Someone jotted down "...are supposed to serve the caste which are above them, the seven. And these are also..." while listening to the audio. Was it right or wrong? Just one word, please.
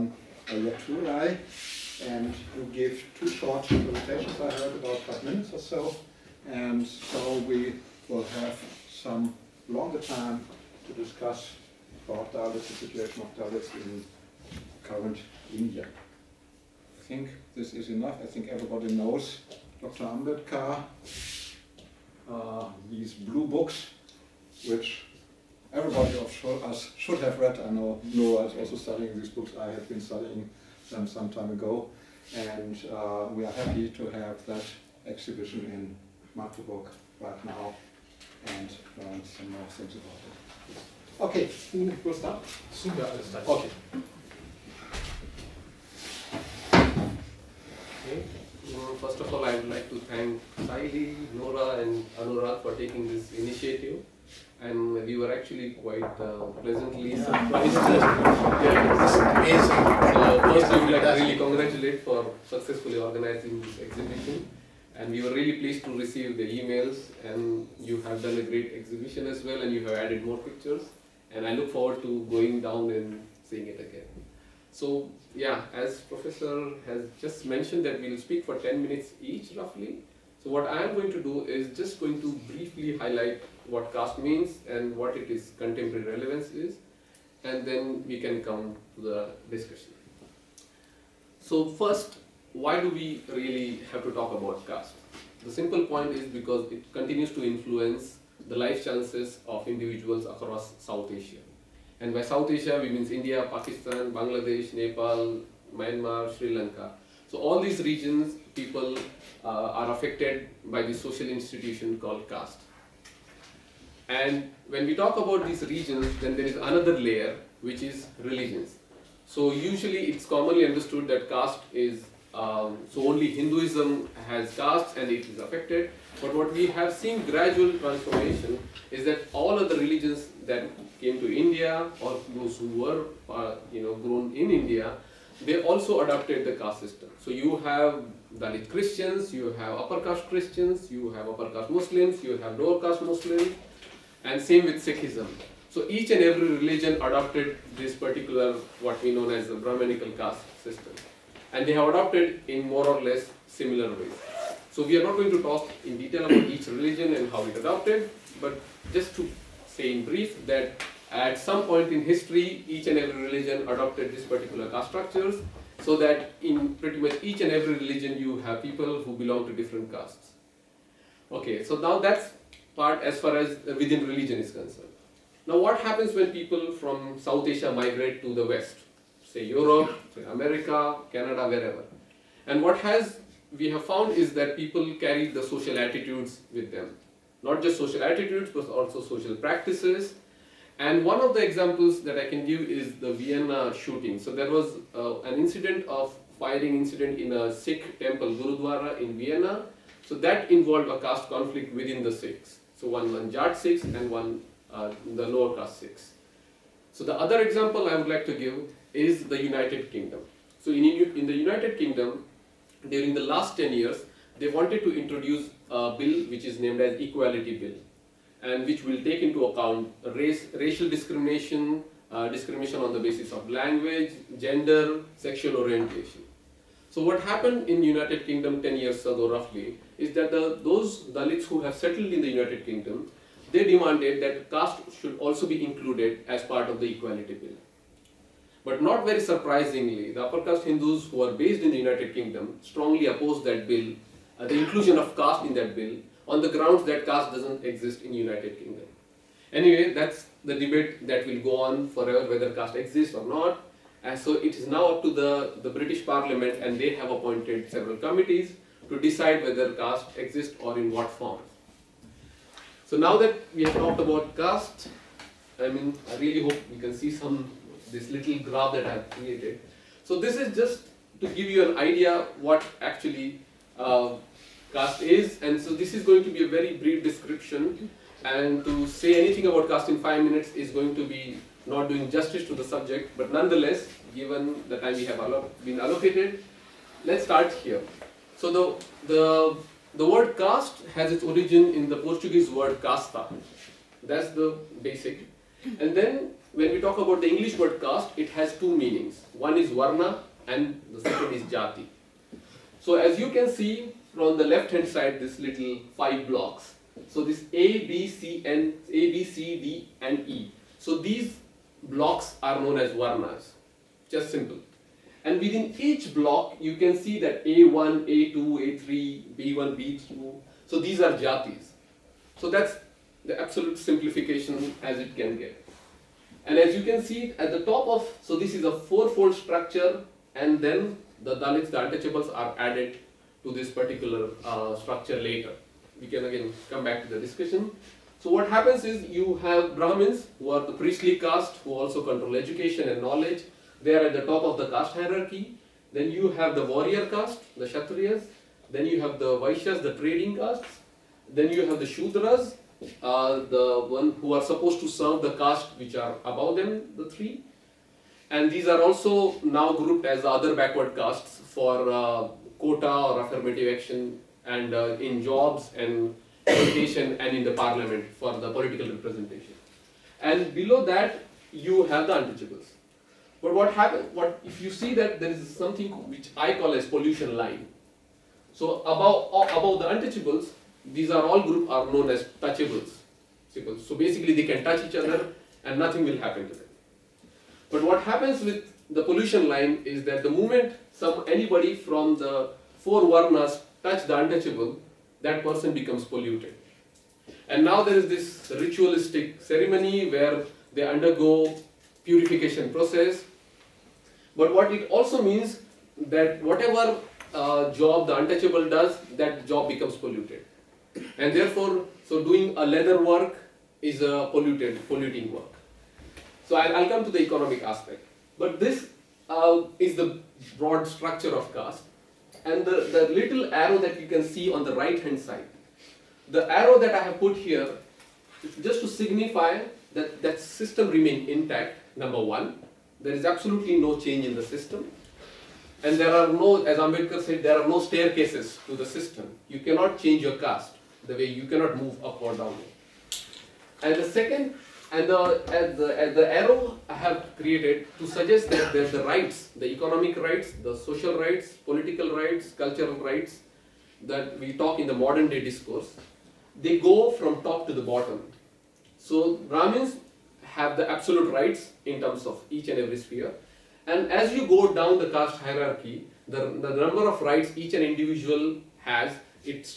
wrong.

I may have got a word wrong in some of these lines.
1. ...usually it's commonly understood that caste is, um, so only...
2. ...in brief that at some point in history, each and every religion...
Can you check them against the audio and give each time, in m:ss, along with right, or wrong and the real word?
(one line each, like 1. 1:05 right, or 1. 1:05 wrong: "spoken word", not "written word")
1. 1:59 right
2. 2:39 right.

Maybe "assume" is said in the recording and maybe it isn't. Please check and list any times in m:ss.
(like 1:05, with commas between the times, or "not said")
not said.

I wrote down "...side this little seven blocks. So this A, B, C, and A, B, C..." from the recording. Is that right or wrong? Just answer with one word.
wrong.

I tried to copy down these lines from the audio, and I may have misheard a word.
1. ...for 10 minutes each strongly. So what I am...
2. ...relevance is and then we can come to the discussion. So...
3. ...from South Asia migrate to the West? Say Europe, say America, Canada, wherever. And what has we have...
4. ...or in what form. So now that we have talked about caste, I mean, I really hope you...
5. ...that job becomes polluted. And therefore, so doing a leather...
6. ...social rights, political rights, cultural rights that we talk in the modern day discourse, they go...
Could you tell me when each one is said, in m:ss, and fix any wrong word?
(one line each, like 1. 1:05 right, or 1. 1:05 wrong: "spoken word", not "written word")
1. 1:18 wrong: "roughly", not "strongly"
2. 1:26 right
3. 2:56 right
4. 4:20 right
5. 6:49 right
6. 7:30 right.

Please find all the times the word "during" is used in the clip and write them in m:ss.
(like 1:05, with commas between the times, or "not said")
3:32.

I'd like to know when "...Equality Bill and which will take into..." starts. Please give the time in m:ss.
3:36.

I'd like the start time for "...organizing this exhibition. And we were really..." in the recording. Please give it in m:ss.
1:02.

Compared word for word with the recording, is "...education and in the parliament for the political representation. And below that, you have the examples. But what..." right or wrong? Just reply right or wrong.
wrong.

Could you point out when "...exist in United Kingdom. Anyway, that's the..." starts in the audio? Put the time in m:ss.
4:07.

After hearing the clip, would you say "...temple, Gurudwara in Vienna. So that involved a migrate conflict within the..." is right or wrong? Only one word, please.
wrong.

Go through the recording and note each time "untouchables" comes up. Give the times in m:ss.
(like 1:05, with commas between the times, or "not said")
5:31, 6:12, 6:19, 6:34, 6:48.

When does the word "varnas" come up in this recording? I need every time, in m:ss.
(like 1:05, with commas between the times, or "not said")
4:59, 5:12, 6:33.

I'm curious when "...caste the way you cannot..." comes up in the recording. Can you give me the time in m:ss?
7:20.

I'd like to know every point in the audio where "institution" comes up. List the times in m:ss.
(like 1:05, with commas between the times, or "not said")
1:51.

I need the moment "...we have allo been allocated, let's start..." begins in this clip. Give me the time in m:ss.
4:44.